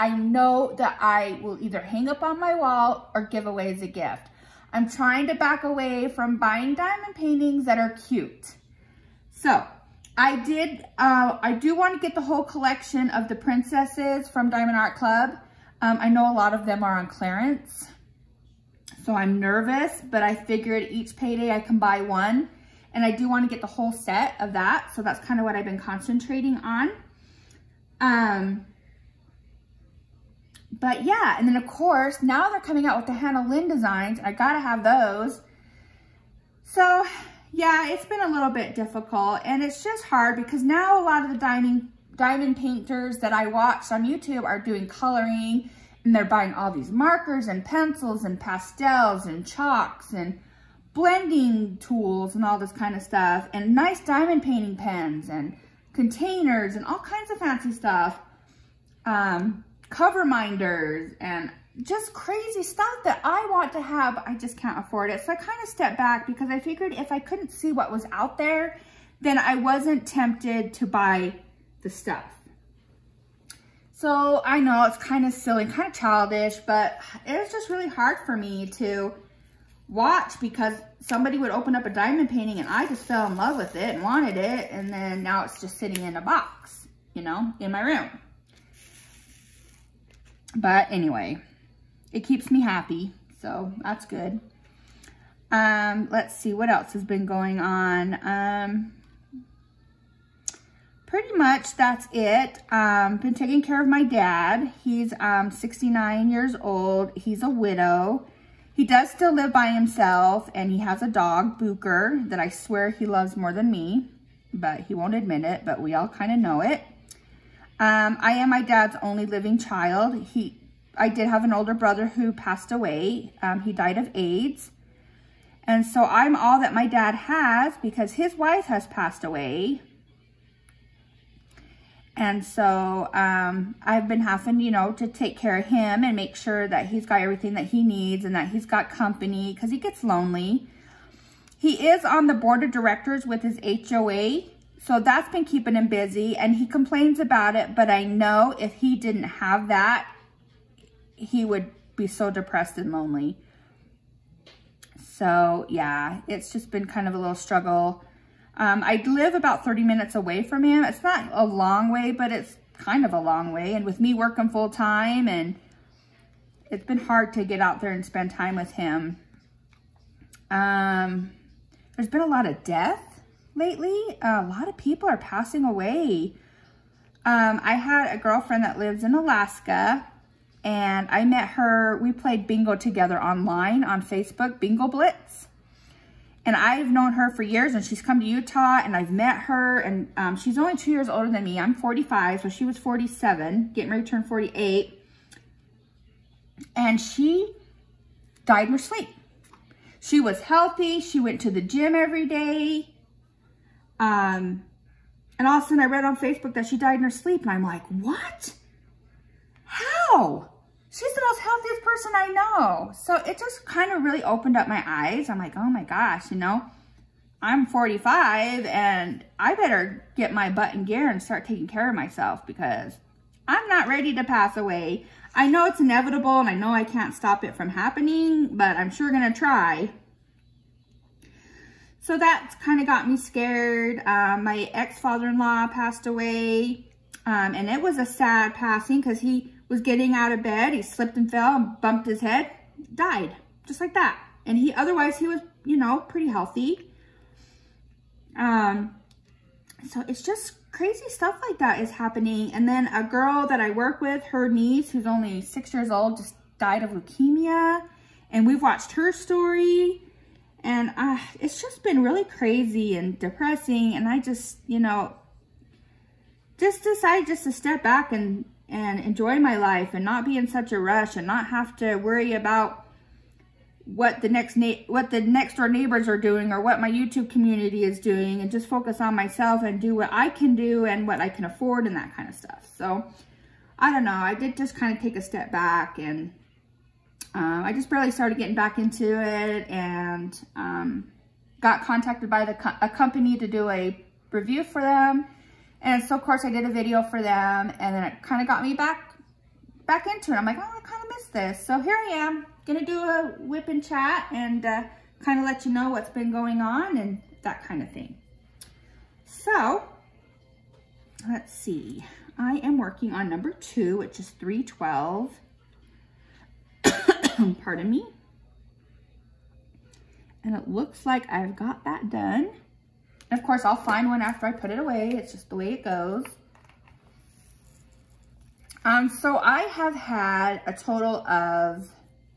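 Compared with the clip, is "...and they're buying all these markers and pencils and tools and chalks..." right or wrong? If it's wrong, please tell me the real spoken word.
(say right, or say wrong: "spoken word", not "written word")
wrong: "pastels", not "tools".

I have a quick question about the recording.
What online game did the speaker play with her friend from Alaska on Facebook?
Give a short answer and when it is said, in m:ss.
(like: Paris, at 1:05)
Bingo Blitz, at 3:04.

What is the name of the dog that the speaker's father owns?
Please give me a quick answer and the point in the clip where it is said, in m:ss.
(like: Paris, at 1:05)
Booker, at 1:51.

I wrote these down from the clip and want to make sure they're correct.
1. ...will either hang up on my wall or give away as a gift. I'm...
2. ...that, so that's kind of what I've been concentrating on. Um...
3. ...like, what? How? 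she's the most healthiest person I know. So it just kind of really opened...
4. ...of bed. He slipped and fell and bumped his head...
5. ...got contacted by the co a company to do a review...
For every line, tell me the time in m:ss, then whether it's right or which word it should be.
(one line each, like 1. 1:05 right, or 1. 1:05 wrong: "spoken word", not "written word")
1. 0:01 right
2. 0:24 right
3. 3:27 right
4. 4:00 right
5. 4:51 right.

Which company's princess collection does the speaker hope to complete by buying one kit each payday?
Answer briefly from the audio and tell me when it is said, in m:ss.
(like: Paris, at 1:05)
Diamond Art Club, at 0:14.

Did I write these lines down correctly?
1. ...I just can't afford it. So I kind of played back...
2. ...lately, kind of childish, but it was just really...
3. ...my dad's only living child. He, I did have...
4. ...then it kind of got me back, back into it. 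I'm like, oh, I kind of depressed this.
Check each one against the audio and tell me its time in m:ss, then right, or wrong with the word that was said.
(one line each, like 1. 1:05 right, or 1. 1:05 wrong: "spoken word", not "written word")
1. 1:04 wrong: "stepped", not "played"
2. 1:15 wrong: "silly", not "lately"
3. 1:58 right
4. 4:57 wrong: "missed", not "depressed".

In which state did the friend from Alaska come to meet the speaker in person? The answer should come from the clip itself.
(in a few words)
Utah.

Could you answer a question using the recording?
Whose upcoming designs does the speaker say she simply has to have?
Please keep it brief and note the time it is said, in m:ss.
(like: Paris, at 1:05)
Hannah Lynn, at 0:33.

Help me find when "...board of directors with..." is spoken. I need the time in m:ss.
2:22.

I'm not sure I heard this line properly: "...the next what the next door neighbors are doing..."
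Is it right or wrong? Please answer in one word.
right.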